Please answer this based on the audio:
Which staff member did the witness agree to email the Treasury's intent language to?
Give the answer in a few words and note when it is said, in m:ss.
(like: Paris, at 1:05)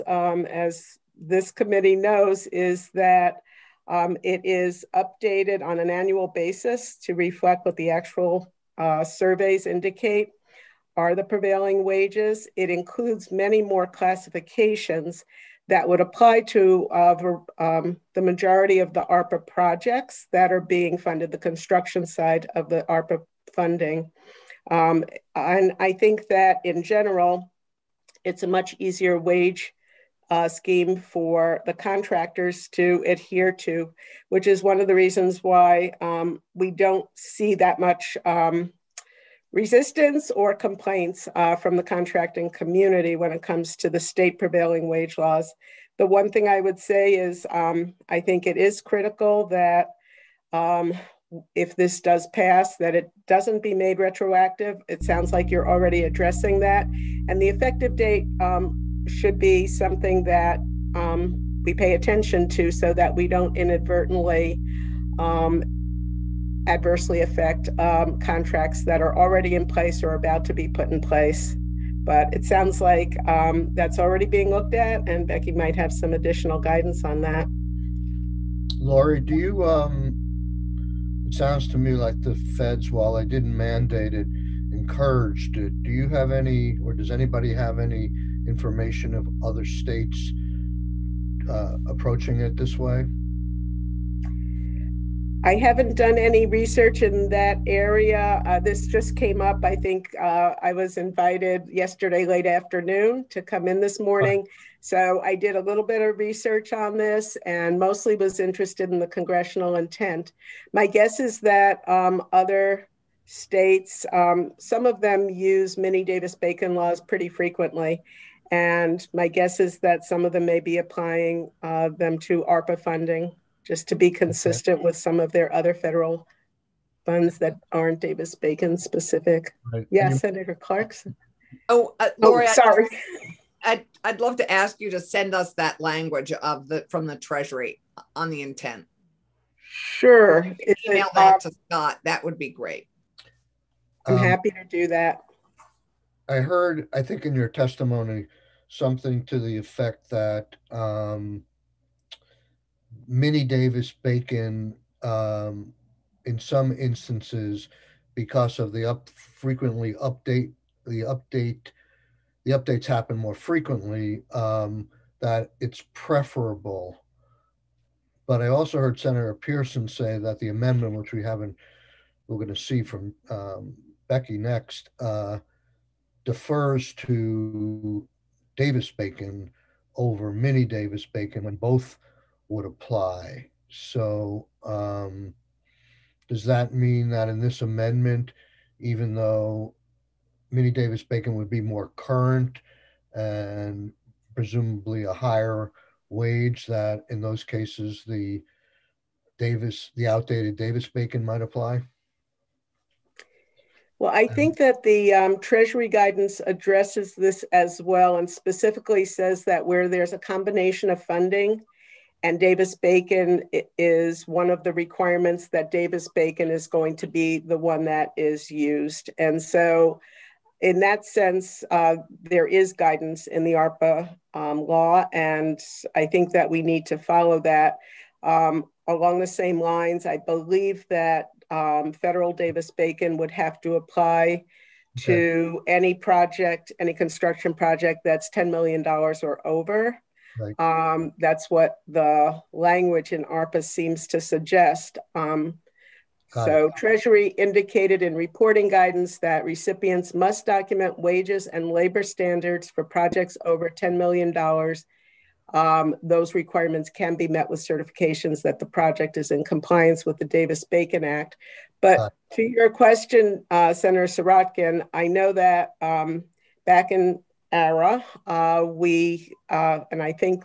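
Scott, at 2:21.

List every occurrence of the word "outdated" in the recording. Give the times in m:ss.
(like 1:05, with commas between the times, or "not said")
3:20.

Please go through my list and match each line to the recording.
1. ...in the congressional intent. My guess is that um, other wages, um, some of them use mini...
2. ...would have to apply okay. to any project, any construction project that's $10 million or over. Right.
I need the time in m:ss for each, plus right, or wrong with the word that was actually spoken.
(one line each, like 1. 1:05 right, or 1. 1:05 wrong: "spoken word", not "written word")
1. 1:48 wrong: "states", not "wages"
2. 3:53 right.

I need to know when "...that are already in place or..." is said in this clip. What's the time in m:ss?
1:08.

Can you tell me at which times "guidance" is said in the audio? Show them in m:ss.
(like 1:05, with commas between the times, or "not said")
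1:16, 3:25, 3:42, 4:08.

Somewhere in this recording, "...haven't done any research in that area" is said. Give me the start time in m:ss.
1:35.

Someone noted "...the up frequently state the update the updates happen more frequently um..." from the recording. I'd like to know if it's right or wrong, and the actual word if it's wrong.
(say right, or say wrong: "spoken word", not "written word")
wrong: "update", not "state".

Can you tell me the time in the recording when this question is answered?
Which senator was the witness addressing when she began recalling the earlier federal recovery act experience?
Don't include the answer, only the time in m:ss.
4:23.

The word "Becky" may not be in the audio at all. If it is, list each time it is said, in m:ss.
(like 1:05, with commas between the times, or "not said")
1:15, 2:54.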